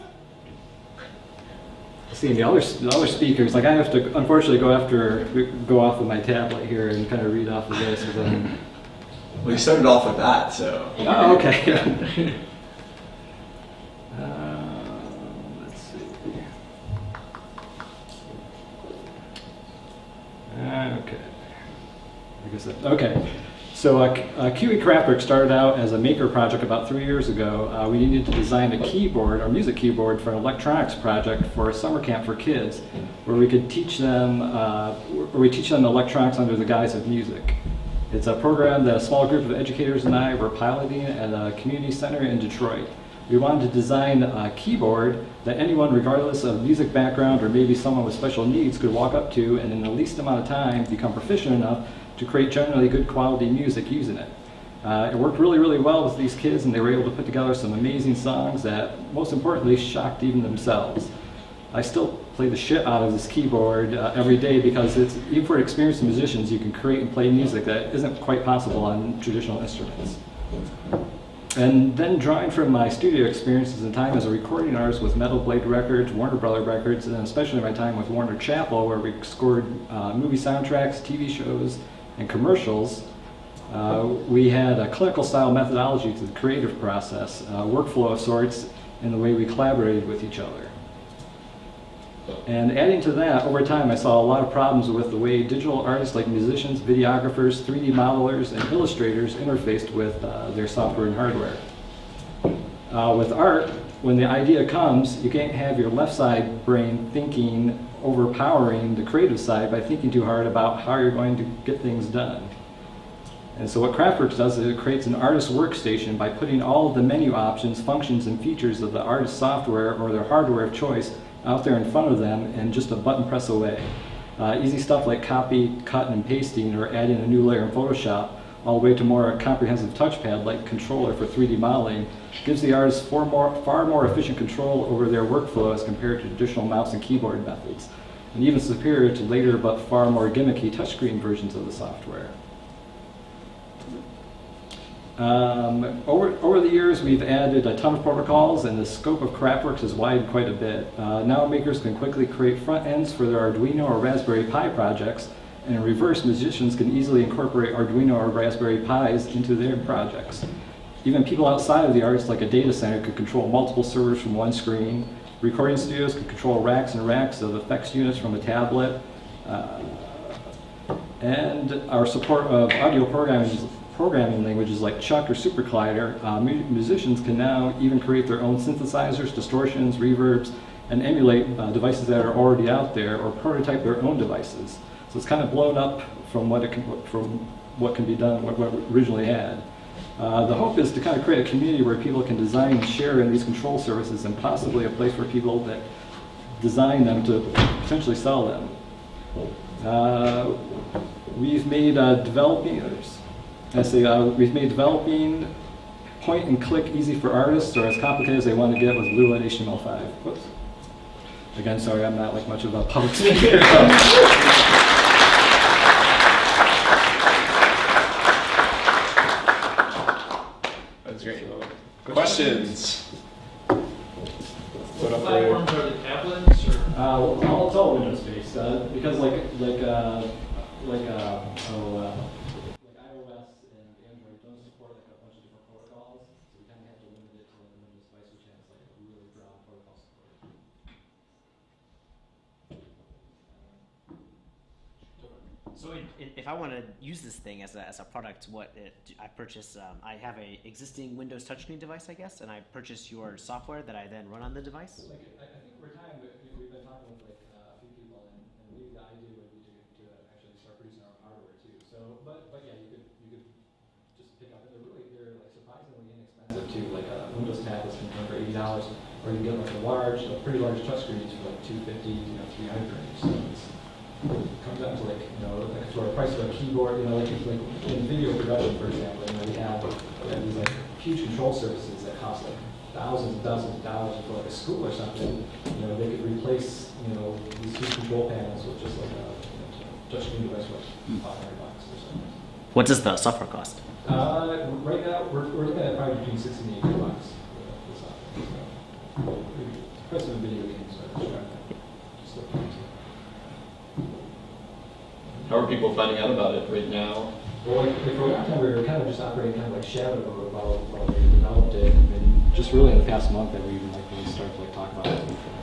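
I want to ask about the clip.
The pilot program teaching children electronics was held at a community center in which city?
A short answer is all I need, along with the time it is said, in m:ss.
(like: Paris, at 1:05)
Detroit, at 0:42.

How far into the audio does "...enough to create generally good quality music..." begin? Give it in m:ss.
0:51.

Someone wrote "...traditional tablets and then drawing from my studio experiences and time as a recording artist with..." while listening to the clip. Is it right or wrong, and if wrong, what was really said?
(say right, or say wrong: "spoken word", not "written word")
wrong: "instruments", not "tablets".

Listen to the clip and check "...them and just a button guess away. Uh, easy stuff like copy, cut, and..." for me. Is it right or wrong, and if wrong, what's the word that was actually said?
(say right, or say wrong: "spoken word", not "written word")
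wrong: "press", not "guess".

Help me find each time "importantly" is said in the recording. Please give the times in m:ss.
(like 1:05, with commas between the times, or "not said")
0:59.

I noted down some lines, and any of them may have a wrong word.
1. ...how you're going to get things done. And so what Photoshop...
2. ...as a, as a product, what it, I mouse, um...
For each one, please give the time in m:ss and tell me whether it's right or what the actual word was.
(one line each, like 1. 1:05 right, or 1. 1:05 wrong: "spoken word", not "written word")
1. 1:50 wrong: "Craftworks", not "Photoshop"
2. 4:07 wrong: "purchase", not "mouse".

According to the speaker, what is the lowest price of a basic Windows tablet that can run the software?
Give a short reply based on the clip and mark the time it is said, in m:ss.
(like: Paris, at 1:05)
$80, at 4:28.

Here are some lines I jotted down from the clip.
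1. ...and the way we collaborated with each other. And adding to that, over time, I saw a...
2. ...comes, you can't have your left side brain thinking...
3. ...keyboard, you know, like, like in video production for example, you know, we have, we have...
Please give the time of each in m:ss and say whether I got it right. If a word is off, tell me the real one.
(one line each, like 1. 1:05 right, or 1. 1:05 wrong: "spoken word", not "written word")
1. 1:29 right
2. 1:44 right
3. 4:36 right.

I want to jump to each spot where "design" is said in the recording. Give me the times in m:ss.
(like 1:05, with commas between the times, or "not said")
0:28, 0:43, 3:12, 3:16.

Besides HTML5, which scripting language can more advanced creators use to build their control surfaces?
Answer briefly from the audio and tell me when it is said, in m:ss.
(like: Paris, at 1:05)
Lua, at 3:29.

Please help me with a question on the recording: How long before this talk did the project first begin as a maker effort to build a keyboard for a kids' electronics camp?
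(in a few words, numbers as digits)
3 years.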